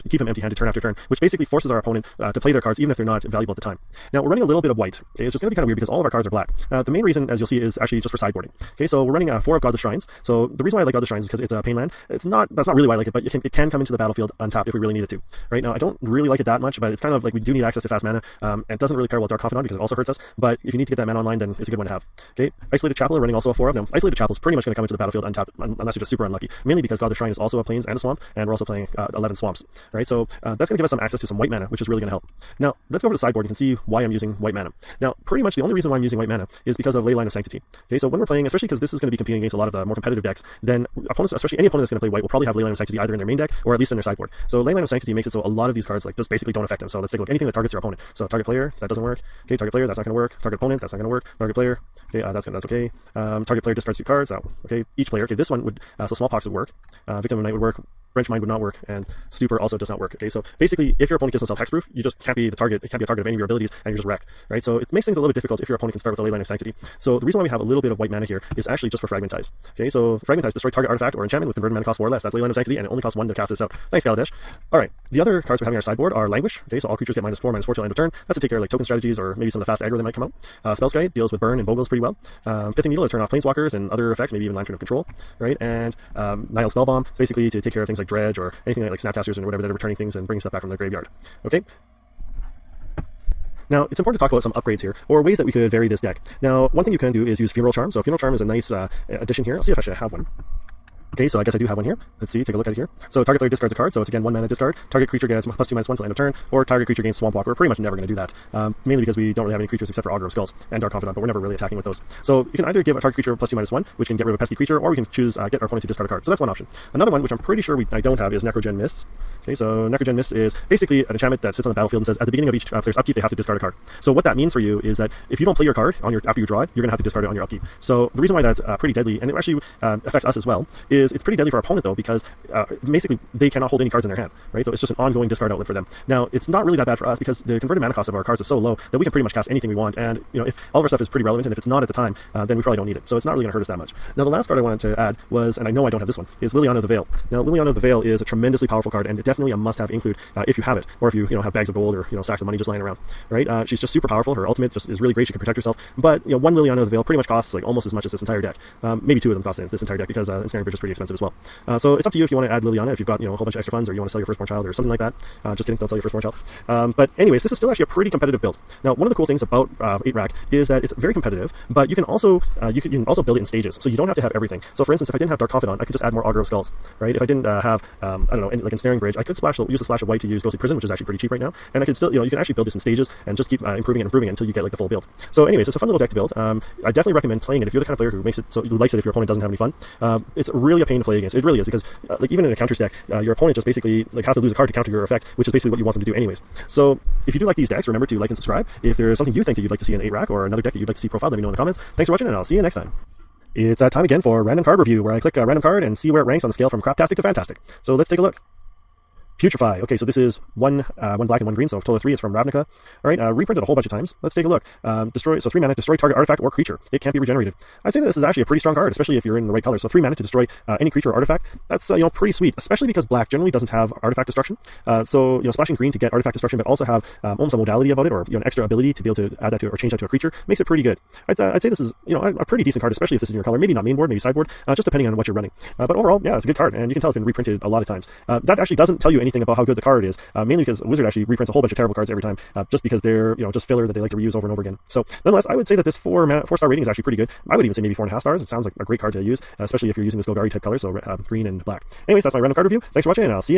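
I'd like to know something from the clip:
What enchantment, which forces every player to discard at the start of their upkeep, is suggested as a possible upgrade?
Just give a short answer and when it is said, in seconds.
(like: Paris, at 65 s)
Necrogen Mists, at 118 s.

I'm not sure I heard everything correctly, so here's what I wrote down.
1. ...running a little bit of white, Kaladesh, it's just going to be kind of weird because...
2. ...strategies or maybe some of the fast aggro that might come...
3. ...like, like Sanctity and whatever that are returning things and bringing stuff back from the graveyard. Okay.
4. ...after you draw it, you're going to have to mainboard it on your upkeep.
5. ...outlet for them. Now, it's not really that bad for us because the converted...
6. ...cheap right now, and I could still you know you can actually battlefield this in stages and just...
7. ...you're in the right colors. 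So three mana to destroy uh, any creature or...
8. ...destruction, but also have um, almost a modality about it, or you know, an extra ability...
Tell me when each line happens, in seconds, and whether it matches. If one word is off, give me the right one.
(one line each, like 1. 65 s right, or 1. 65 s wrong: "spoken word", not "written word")
1. 4 s wrong: "Okay", not "Kaladesh"
2. 78 s right
3. 88 s wrong: "Snapcasters", not "Sanctity"
4. 126 s wrong: "discard", not "mainboard"
5. 135 s right
6. 181 s wrong: "build", not "battlefield"
7. 219 s right
8. 226 s right.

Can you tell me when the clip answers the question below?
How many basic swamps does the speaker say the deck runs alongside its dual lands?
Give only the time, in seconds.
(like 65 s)
29 s.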